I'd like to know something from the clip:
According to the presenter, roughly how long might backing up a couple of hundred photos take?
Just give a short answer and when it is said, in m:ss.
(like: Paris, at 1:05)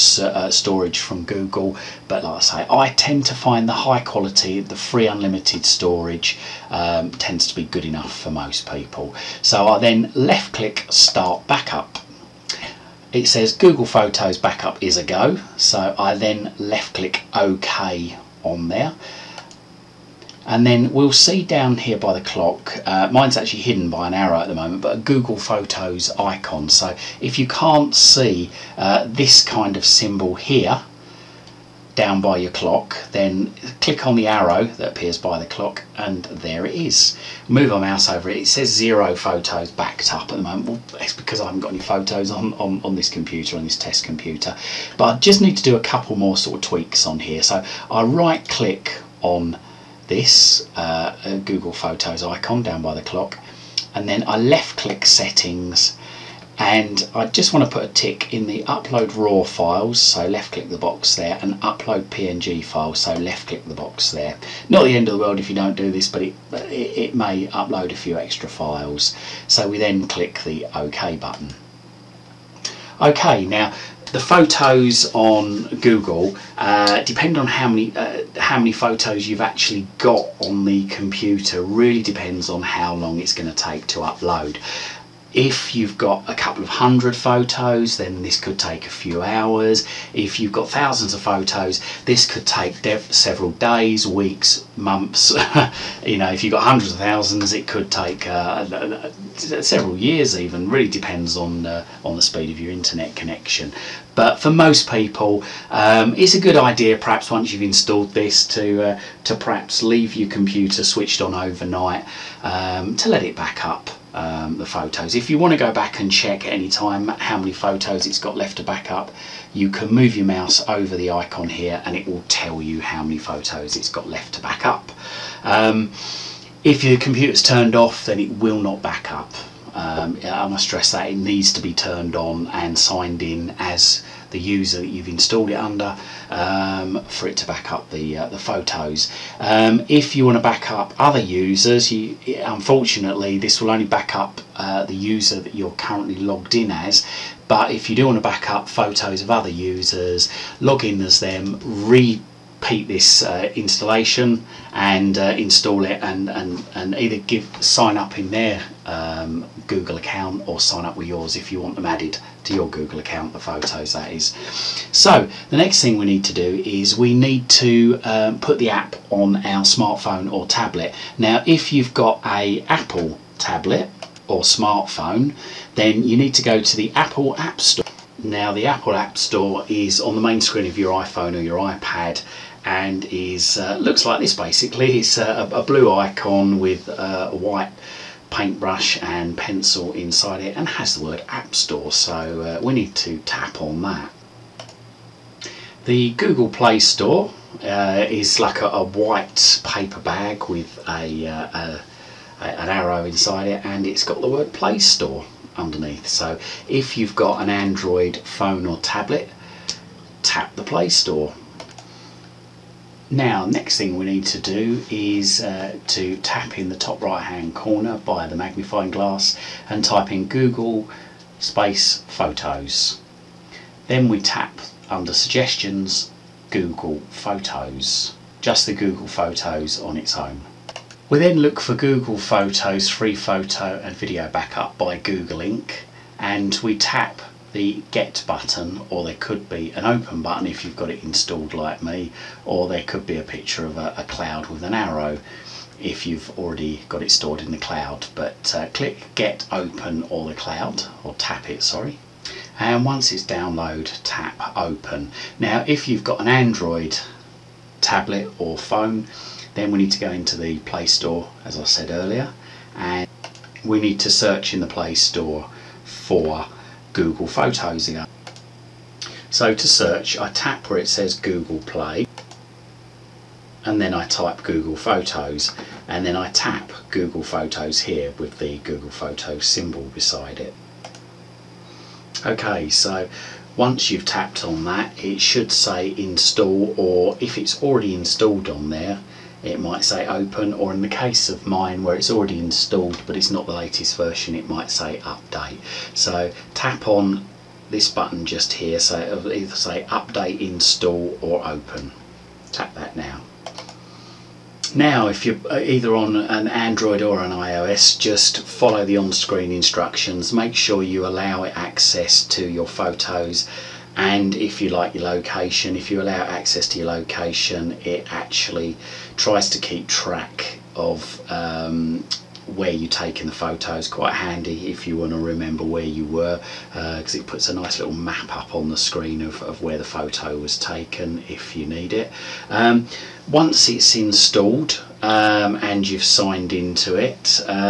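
a few hours, at 1:28.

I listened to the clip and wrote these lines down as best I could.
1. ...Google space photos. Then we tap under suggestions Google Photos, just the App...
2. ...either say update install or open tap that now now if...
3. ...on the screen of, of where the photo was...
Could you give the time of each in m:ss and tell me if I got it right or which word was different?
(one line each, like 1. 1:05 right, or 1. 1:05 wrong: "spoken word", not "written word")
1. 3:40 wrong: "Google", not "App"
2. 4:59 right
3. 5:28 right.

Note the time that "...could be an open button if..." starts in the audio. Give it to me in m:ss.
3:59.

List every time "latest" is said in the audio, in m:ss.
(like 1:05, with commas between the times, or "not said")
4:53.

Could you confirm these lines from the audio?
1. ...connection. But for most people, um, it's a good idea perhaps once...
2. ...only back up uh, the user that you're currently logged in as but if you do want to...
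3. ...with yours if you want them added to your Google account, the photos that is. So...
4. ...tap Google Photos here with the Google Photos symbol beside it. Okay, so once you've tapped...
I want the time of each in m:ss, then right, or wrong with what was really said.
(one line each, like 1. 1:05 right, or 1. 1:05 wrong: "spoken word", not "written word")
1. 1:43 right
2. 2:23 right
3. 2:40 right
4. 4:36 right.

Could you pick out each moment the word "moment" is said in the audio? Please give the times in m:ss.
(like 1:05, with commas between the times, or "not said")
0:24, 0:40.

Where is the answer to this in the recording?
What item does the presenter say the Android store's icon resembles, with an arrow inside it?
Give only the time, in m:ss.
3:18.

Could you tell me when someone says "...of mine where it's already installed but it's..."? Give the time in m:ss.
4:51.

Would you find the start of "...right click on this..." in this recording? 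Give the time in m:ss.
0:48.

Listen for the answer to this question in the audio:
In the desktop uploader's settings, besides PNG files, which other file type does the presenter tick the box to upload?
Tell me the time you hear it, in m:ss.
0:59.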